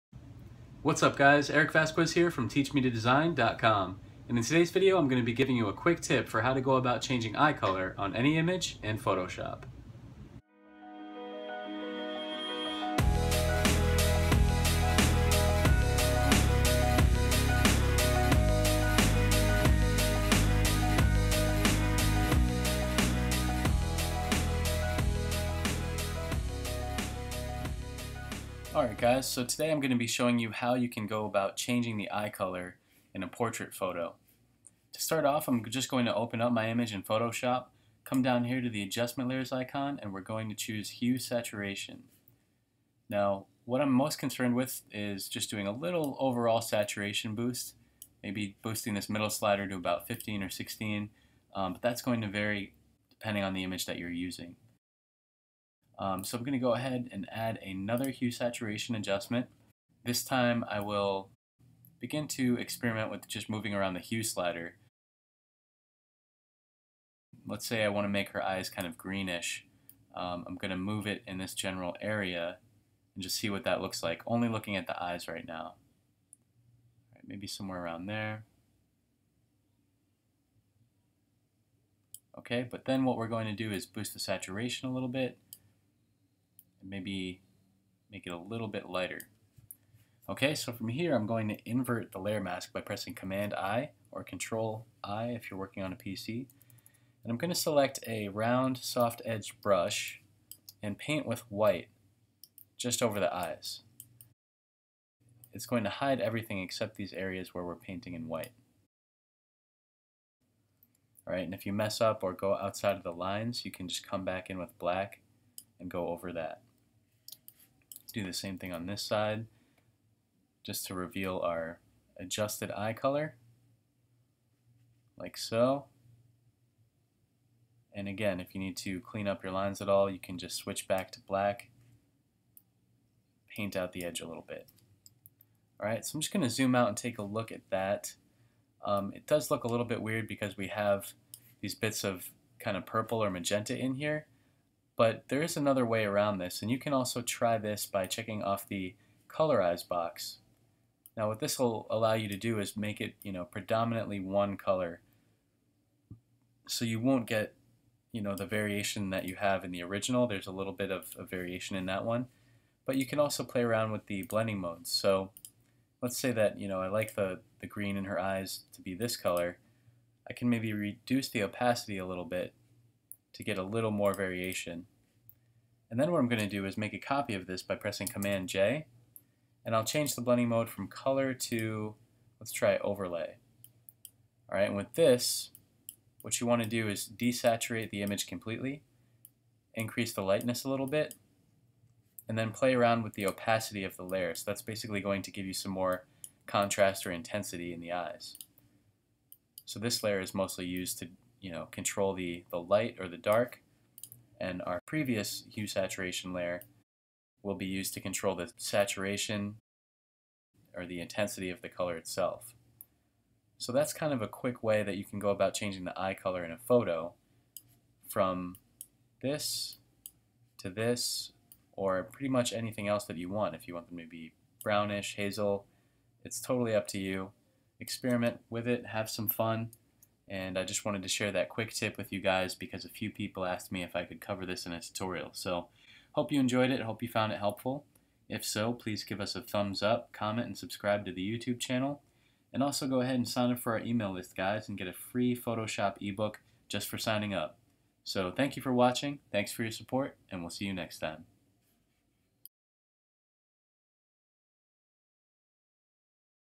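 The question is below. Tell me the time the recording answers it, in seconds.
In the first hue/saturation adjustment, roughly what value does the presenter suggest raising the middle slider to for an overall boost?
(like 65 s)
50 s.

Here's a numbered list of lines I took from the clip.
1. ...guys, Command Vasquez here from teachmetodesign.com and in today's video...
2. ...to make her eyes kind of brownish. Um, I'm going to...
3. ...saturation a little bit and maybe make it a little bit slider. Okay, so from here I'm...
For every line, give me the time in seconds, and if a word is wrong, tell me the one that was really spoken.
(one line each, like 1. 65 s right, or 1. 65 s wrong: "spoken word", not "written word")
1. 1 s wrong: "Eric", not "Command"
2. 68 s wrong: "greenish", not "brownish"
3. 84 s wrong: "lighter", not "slider".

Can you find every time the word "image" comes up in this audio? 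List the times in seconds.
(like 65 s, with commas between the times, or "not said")
8 s, 36 s, 53 s, 188 s.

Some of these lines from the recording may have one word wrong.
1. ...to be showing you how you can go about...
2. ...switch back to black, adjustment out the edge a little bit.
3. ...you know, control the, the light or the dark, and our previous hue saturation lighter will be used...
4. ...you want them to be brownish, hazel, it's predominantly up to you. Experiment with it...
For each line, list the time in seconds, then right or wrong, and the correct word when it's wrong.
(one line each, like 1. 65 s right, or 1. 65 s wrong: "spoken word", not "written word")
1. 29 s right
2. 130 s wrong: "paint", not "adjustment"
3. 201 s wrong: "layer", not "lighter"
4. 223 s wrong: "totally", not "predominantly".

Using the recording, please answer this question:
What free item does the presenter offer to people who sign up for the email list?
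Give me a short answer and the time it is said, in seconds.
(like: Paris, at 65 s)
Photoshop ebook, at 245 s.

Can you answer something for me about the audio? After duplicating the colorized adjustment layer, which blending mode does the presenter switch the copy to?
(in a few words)
Overlay.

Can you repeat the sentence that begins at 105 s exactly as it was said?
It's going to hide everything except these areas where we're painting in white.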